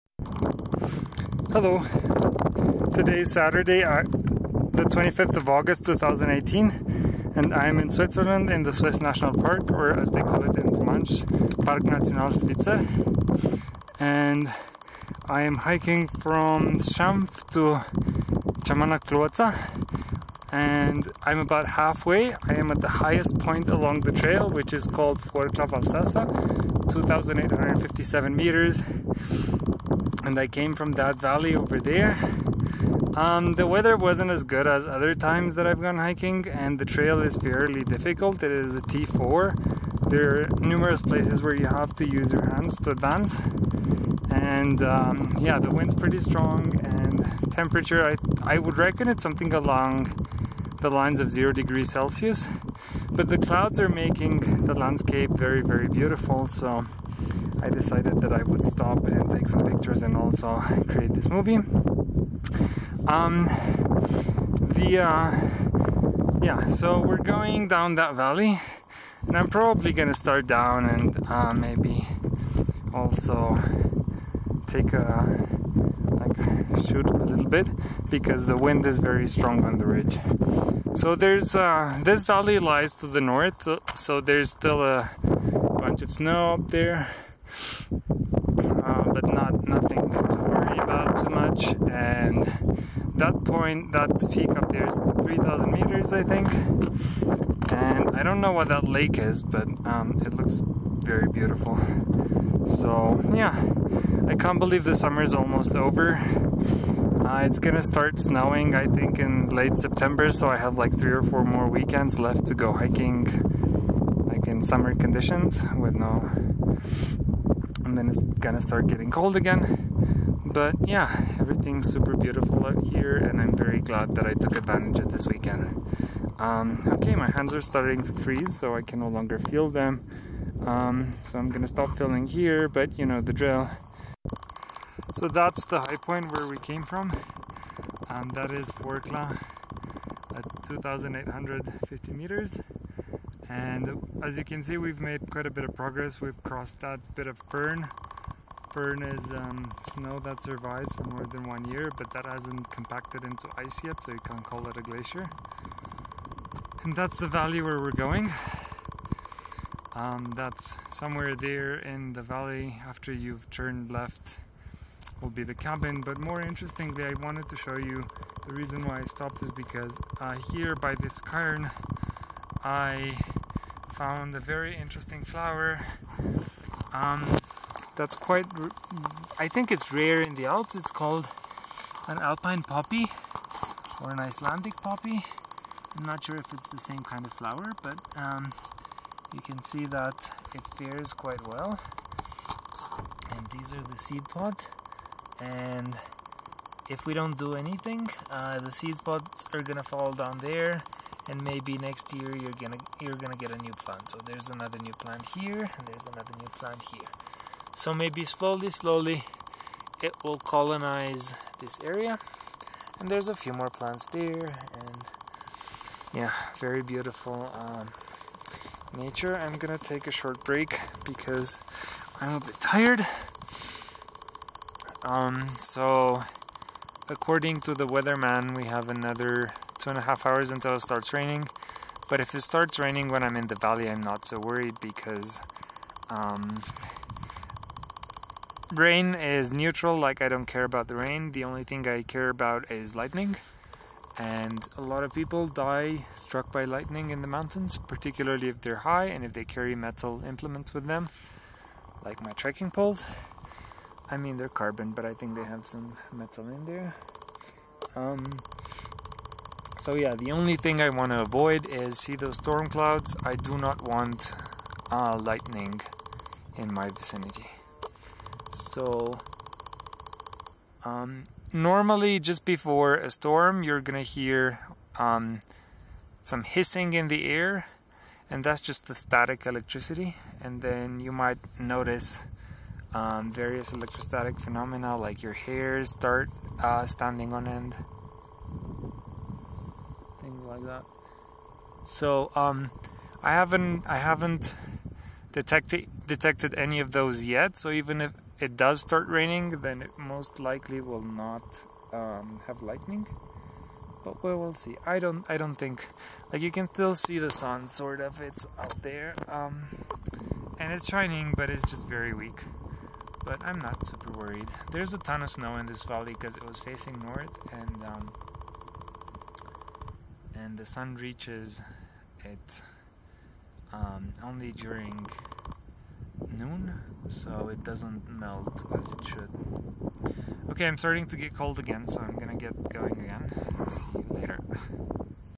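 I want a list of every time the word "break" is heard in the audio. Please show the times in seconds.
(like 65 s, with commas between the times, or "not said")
220 s.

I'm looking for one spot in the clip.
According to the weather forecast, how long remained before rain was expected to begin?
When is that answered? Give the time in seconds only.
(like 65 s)
229 s.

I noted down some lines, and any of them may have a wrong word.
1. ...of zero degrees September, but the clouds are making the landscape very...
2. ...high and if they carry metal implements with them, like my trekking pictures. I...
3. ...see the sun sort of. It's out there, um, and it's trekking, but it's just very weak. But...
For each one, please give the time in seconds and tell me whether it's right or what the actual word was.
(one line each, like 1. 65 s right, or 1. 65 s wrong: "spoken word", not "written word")
1. 51 s wrong: "Celsius", not "September"
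2. 248 s wrong: "poles", not "pictures"
3. 306 s wrong: "shining", not "trekking".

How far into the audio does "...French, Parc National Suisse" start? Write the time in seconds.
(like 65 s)
10 s.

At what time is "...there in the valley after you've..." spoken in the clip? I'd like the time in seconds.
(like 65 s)
161 s.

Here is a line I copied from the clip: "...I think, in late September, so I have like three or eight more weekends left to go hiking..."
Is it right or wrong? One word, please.
wrong.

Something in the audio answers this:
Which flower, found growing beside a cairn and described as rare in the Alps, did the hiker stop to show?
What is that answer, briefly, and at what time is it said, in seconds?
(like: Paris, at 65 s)
Alpine poppy, at 182 s.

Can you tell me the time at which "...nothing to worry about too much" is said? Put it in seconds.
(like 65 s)
89 s.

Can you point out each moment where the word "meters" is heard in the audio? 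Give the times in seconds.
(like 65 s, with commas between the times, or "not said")
28 s, 95 s, 142 s.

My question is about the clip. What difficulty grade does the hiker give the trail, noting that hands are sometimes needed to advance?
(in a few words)
T4.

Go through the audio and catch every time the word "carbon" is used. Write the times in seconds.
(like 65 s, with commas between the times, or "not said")
254 s.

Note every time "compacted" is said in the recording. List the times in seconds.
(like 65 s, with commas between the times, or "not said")
152 s.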